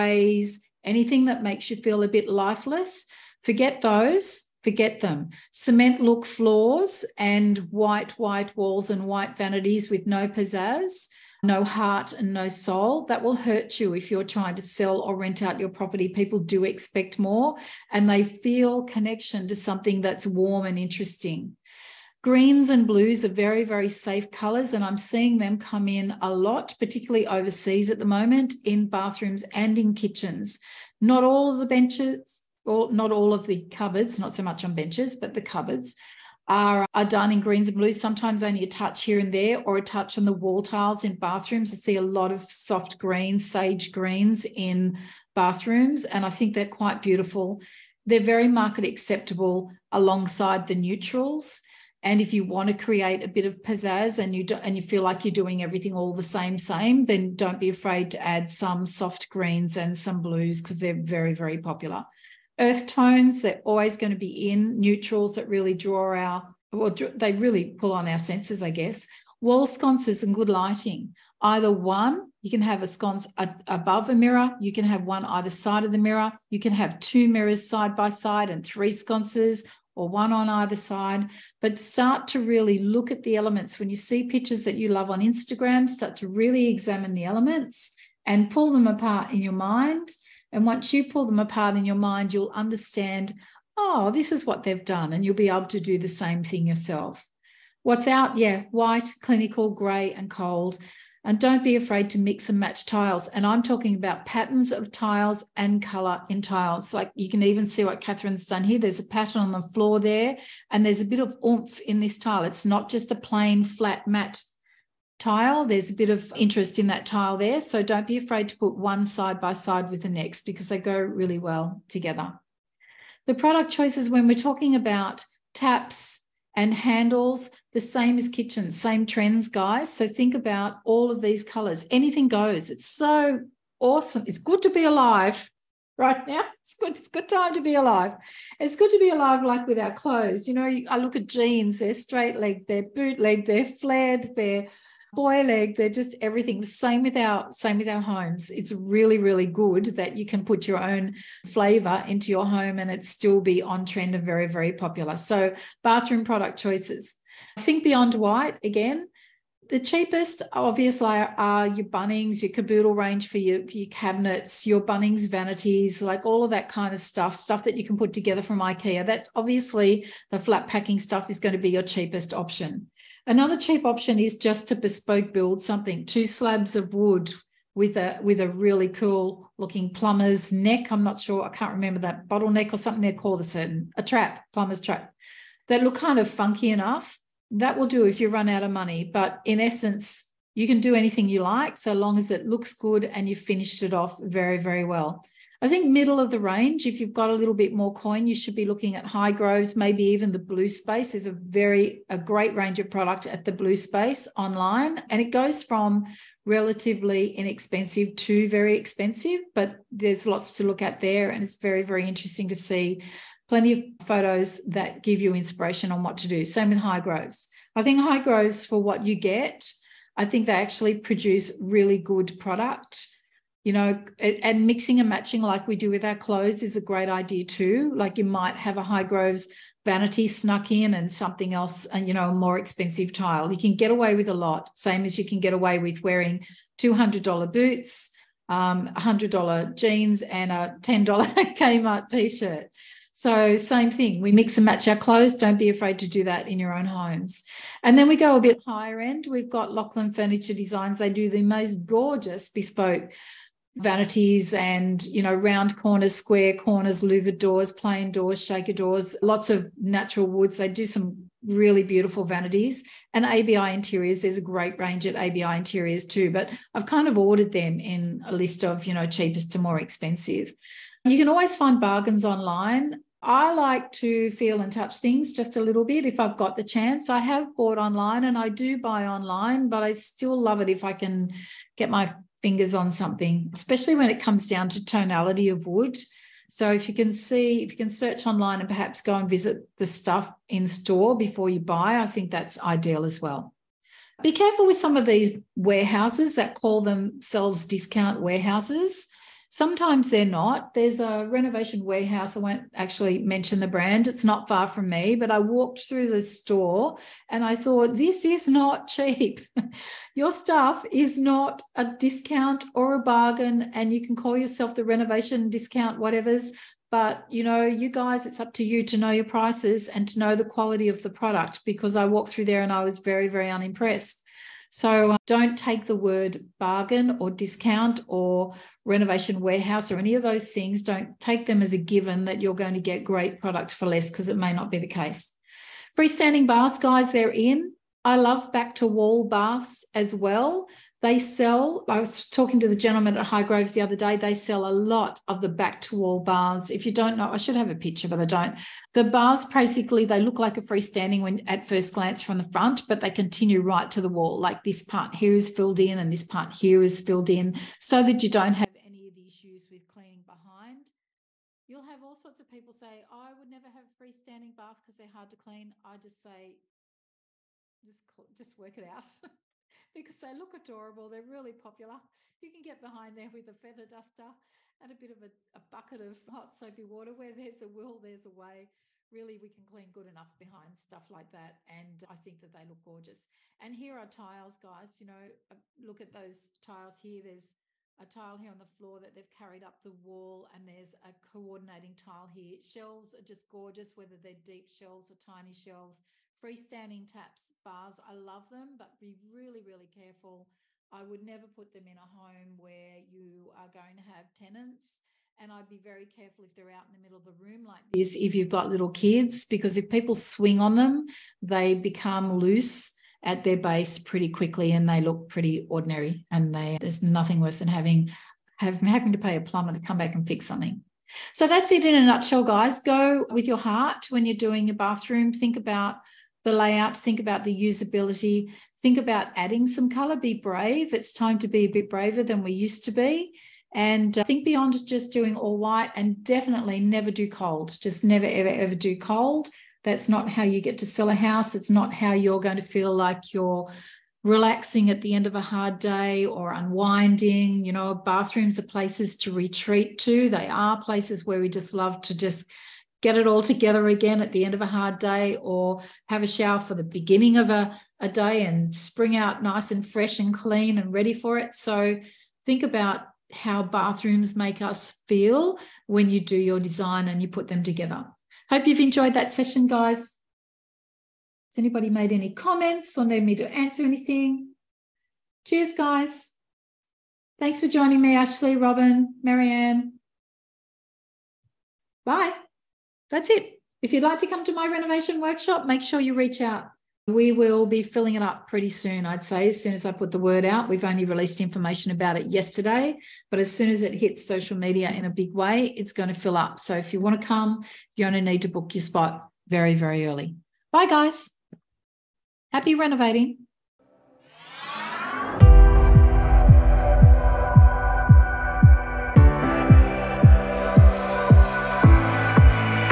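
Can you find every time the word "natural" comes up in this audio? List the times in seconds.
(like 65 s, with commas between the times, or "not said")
259 s.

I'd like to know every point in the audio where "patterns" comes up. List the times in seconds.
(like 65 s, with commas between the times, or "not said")
104 s, 109 s.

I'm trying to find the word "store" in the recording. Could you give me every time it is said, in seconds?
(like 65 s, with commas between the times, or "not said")
290 s, 306 s.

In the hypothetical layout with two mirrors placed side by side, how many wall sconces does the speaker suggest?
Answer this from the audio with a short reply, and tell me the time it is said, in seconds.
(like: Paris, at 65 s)
3, at 78 s.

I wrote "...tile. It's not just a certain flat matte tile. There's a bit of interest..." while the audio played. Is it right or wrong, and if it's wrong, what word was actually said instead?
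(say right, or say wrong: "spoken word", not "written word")
wrong: "plain", not "certain".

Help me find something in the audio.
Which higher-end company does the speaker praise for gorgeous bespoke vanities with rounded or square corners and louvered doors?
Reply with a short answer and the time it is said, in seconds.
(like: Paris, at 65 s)
Lachlan Furniture Designs, at 249 s.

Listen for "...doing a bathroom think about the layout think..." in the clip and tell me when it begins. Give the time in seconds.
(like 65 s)
424 s.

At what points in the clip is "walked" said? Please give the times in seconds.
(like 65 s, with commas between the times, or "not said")
305 s, 322 s.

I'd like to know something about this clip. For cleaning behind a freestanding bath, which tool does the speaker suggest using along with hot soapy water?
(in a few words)
feather duster.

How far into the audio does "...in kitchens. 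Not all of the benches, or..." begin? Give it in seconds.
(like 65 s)
29 s.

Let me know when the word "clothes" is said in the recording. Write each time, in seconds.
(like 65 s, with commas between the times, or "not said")
139 s, 226 s, 244 s.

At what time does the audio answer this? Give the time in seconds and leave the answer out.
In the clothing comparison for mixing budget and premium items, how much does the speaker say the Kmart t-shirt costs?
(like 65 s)
240 s.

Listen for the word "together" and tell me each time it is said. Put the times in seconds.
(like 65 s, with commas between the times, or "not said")
121 s, 168 s, 453 s, 467 s.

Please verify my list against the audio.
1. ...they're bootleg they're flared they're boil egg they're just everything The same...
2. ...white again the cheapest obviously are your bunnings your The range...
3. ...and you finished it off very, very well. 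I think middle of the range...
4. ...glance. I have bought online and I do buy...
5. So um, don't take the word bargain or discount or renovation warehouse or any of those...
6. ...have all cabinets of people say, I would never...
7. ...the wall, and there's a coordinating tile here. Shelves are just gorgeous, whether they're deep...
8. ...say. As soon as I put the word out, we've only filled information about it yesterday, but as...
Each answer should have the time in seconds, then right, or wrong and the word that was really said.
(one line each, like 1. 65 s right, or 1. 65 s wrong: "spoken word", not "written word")
1. 142 s right
2. 158 s wrong: "Kaboodle", not "The"
3. 193 s right
4. 276 s wrong: "chance", not "glance"
5. 324 s right
6. 361 s wrong: "sorts", not "cabinets"
7. 389 s right
8. 489 s wrong: "released", not "filled".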